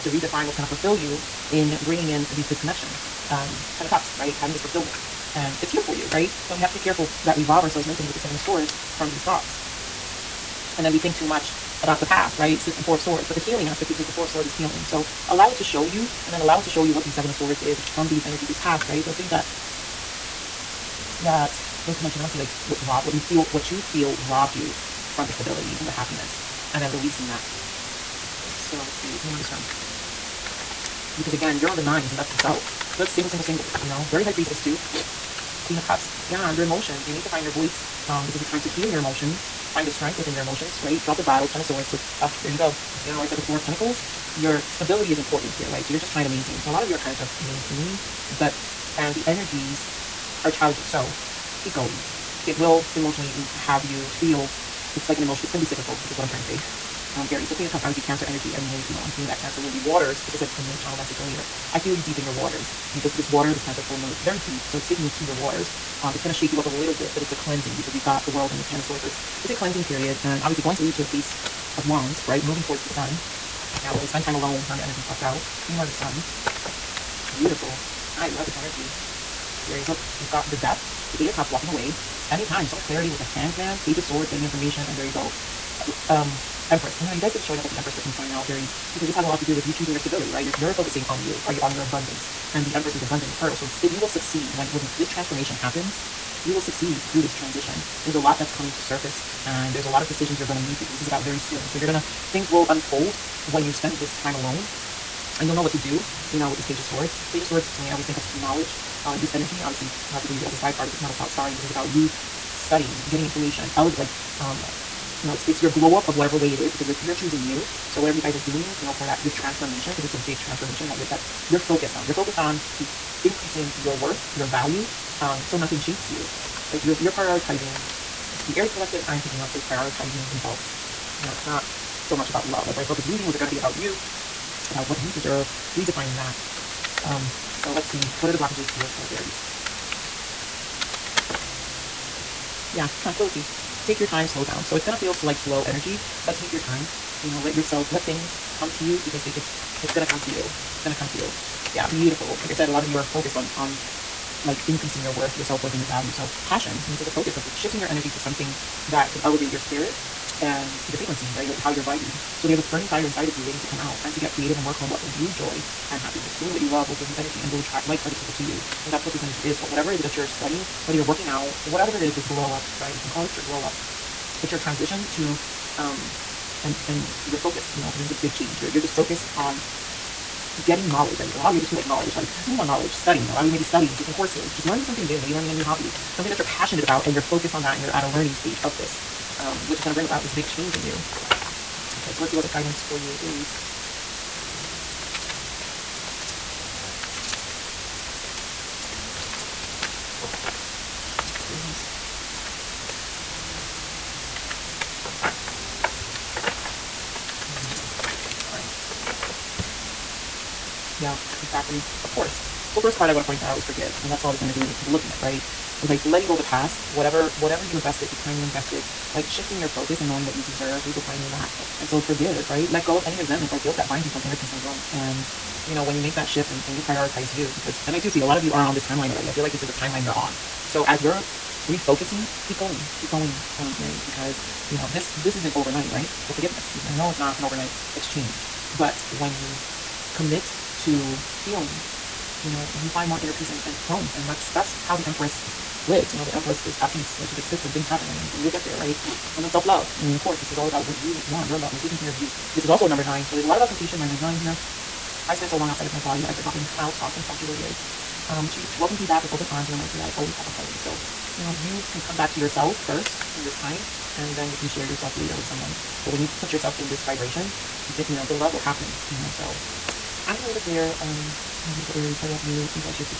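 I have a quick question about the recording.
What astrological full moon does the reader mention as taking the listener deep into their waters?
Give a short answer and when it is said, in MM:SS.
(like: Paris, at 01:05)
Cancer full moon, at 01:03.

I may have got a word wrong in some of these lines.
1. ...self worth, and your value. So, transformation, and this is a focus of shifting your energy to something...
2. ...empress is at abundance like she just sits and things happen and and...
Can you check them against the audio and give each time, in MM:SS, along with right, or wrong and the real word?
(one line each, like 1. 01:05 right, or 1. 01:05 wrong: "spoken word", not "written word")
1. 02:35 wrong: "passion", not "transformation"
2. 04:06 wrong: "peace", not "abundance".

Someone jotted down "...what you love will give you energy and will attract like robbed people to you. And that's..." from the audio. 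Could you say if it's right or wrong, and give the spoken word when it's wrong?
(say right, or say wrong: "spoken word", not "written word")
wrong: "hearted", not "robbed".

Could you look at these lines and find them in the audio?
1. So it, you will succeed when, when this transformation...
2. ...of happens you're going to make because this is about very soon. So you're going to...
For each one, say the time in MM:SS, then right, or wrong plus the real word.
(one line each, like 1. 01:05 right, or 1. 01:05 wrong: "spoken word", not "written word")
1. 01:33 right
2. 01:40 wrong: "decisions", not "happens".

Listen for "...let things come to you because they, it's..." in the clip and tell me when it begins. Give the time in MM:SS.
02:27.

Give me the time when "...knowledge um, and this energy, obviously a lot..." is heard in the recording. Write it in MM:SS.
01:48.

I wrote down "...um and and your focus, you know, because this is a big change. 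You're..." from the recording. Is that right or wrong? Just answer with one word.
right.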